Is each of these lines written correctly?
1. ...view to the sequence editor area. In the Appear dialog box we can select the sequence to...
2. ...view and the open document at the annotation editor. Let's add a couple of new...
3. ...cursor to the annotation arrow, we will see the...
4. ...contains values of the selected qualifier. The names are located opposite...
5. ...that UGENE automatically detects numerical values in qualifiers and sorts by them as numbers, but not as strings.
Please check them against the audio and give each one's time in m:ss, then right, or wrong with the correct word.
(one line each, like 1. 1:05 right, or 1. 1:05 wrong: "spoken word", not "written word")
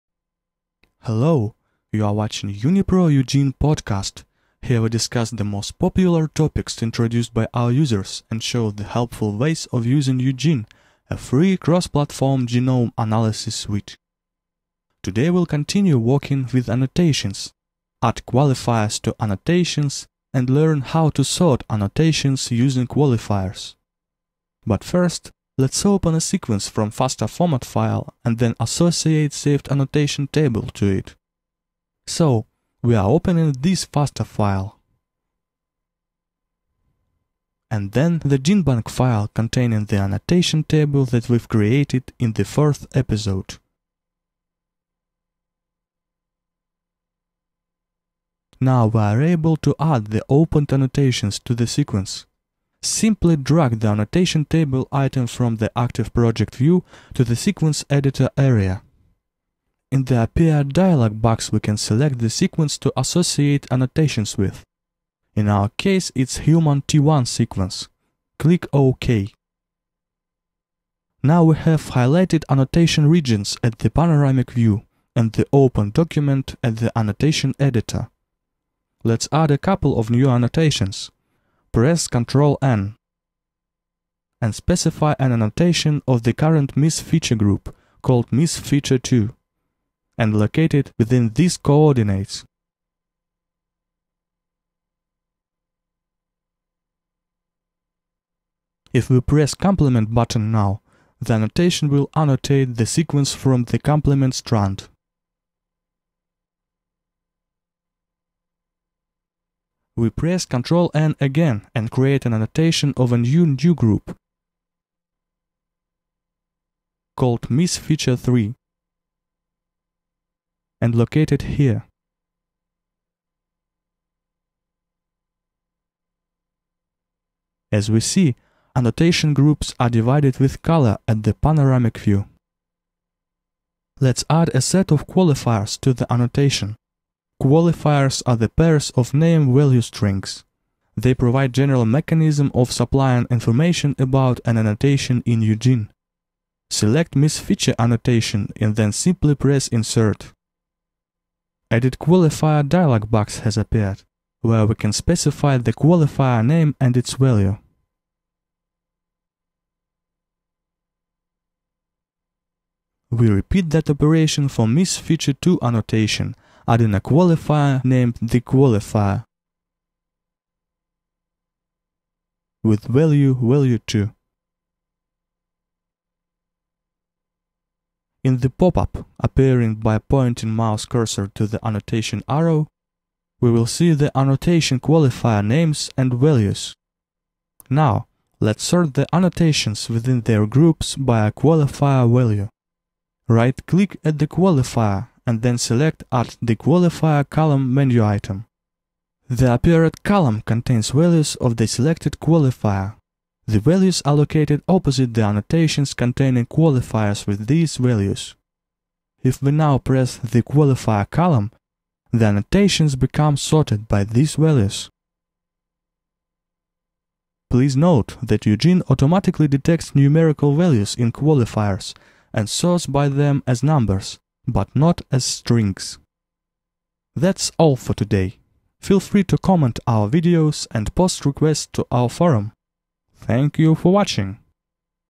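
1. 0:56 right
2. 1:14 right
3. 3:00 right
4. 3:20 wrong: "values", not "names"
5. 3:38 right.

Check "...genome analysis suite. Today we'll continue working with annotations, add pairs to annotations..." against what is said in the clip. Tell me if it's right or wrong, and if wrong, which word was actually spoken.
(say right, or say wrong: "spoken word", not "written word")
wrong: "qualifiers", not "pairs".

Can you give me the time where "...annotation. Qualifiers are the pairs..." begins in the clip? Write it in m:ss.
2:16.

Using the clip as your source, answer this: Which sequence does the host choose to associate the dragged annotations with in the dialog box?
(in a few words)
Human T1.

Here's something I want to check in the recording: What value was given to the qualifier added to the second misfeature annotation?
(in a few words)
value 2.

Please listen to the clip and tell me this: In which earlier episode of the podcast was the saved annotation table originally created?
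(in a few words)
Fourth.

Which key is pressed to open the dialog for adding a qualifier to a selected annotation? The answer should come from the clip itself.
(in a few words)
Insert.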